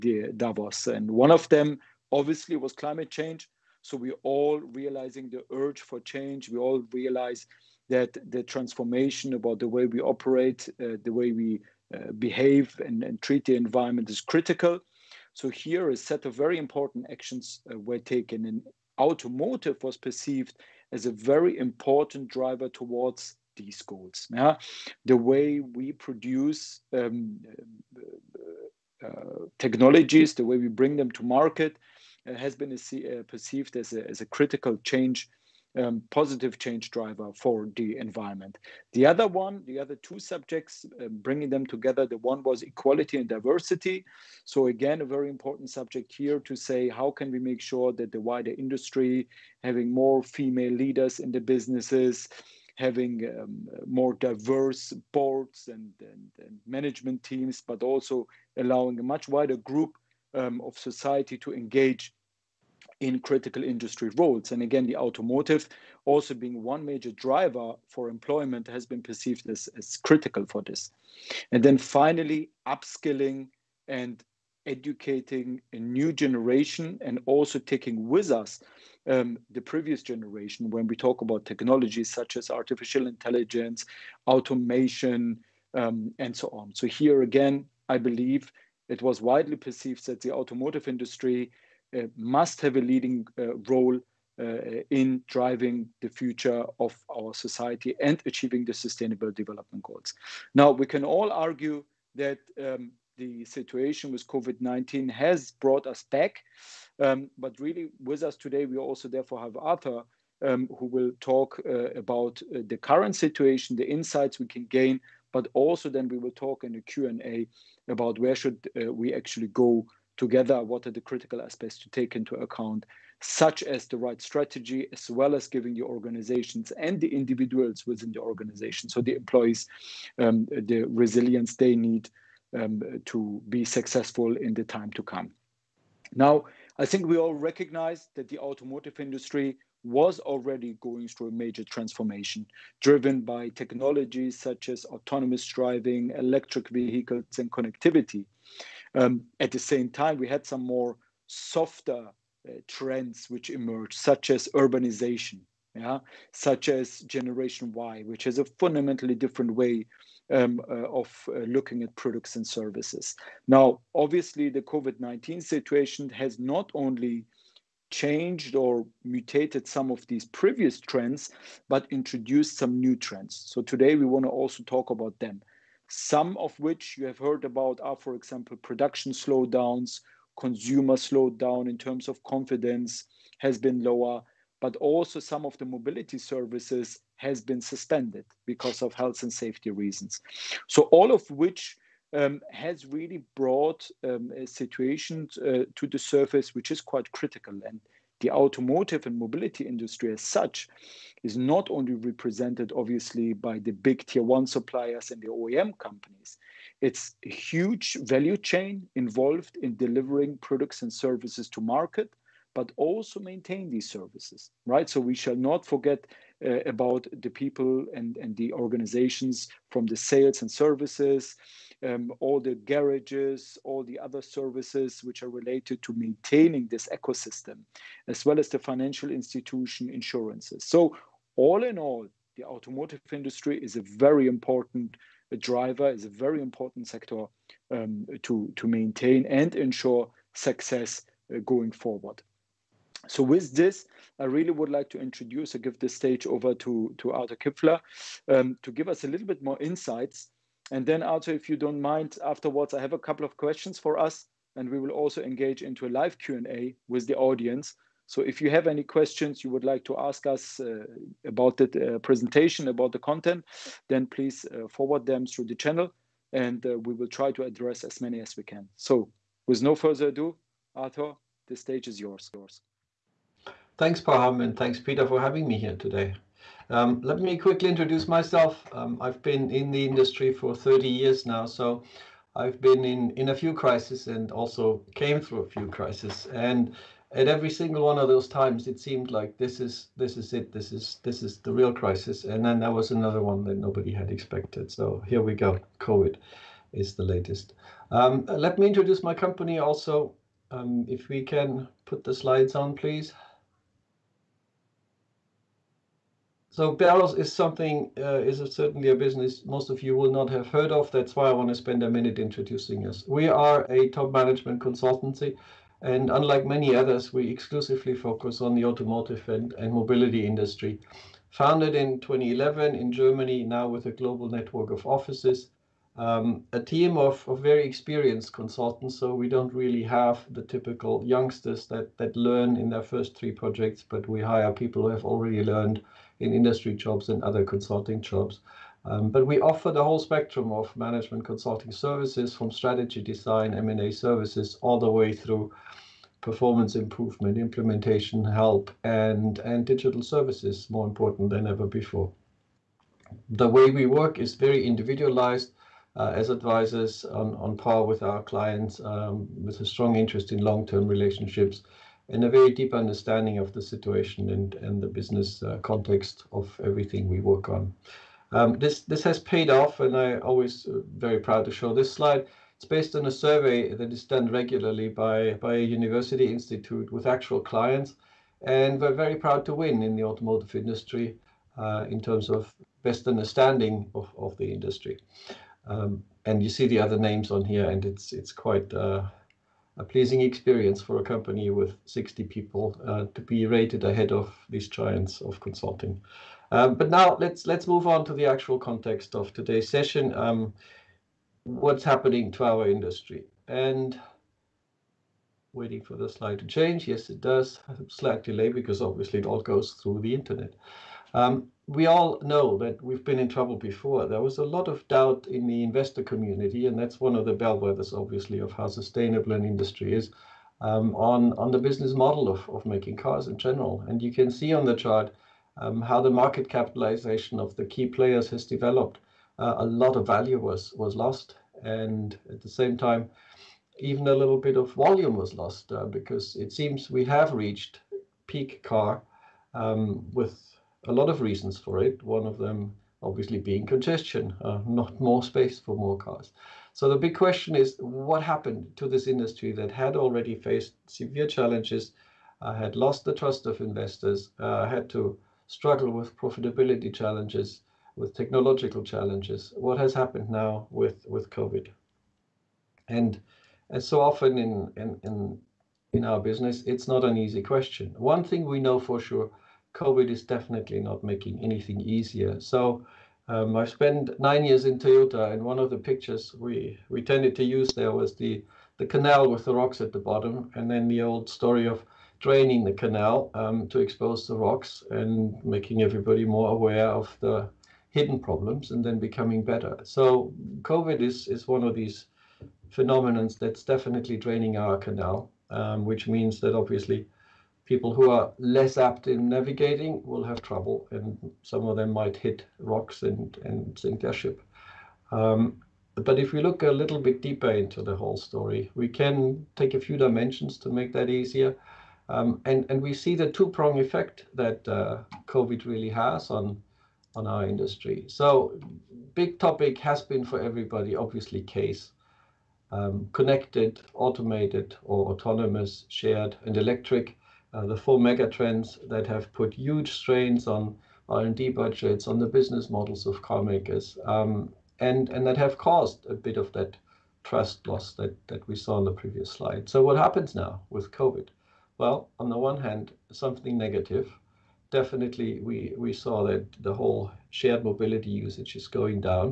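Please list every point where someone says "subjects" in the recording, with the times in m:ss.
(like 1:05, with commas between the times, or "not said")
0:40, 0:45.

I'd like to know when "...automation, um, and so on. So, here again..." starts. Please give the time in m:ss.
1:24.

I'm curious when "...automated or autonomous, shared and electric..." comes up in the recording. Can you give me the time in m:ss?
8:43.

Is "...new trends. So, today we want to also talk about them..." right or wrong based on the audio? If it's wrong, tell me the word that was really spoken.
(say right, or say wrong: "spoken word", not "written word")
right.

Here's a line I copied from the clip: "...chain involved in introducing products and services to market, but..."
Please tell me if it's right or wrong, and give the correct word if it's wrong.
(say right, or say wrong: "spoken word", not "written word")
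wrong: "delivering", not "introducing".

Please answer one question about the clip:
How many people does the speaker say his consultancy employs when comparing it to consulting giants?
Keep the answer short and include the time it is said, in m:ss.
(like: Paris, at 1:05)
60, at 6:31.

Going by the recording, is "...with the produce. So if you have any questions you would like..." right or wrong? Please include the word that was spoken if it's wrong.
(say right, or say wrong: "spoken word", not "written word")
wrong: "audience", not "produce".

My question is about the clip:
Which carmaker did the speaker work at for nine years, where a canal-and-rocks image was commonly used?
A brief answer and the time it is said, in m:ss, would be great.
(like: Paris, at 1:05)
Toyota, at 7:54.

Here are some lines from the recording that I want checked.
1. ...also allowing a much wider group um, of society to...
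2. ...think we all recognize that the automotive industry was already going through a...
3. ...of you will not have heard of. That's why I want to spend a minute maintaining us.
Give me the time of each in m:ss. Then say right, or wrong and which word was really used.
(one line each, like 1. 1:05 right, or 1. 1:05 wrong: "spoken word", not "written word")
1. 0:57 right
2. 2:16 right
3. 5:09 wrong: "introducing", not "maintaining".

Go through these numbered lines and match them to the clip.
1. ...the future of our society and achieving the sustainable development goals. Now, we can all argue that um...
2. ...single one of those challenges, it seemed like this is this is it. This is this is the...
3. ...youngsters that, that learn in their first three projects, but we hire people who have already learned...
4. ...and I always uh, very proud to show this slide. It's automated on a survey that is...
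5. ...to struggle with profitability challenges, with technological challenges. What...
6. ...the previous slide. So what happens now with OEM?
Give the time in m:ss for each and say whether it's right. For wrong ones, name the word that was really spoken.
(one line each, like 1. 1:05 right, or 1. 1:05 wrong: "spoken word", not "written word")
1. 1:36 right
2. 4:47 wrong: "times", not "challenges"
3. 5:31 right
4. 6:09 wrong: "based", not "automated"
5. 7:34 right
6. 8:58 wrong: "COVID", not "OEM".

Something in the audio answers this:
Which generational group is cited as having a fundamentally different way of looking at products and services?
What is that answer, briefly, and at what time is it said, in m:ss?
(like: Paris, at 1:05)
Generation Y, at 2:37.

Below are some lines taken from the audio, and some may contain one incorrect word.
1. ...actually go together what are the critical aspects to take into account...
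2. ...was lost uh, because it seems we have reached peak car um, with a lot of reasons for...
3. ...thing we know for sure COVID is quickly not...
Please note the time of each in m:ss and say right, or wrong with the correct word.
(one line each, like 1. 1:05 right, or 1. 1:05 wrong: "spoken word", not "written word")
1. 1:59 right
2. 7:15 right
3. 7:48 wrong: "definitely", not "quickly".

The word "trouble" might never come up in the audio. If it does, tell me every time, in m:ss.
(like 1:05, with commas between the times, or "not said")
6:53, 8:20.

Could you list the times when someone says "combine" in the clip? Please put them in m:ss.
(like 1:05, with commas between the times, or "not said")
not said.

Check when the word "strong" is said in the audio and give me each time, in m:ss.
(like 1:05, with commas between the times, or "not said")
5:59.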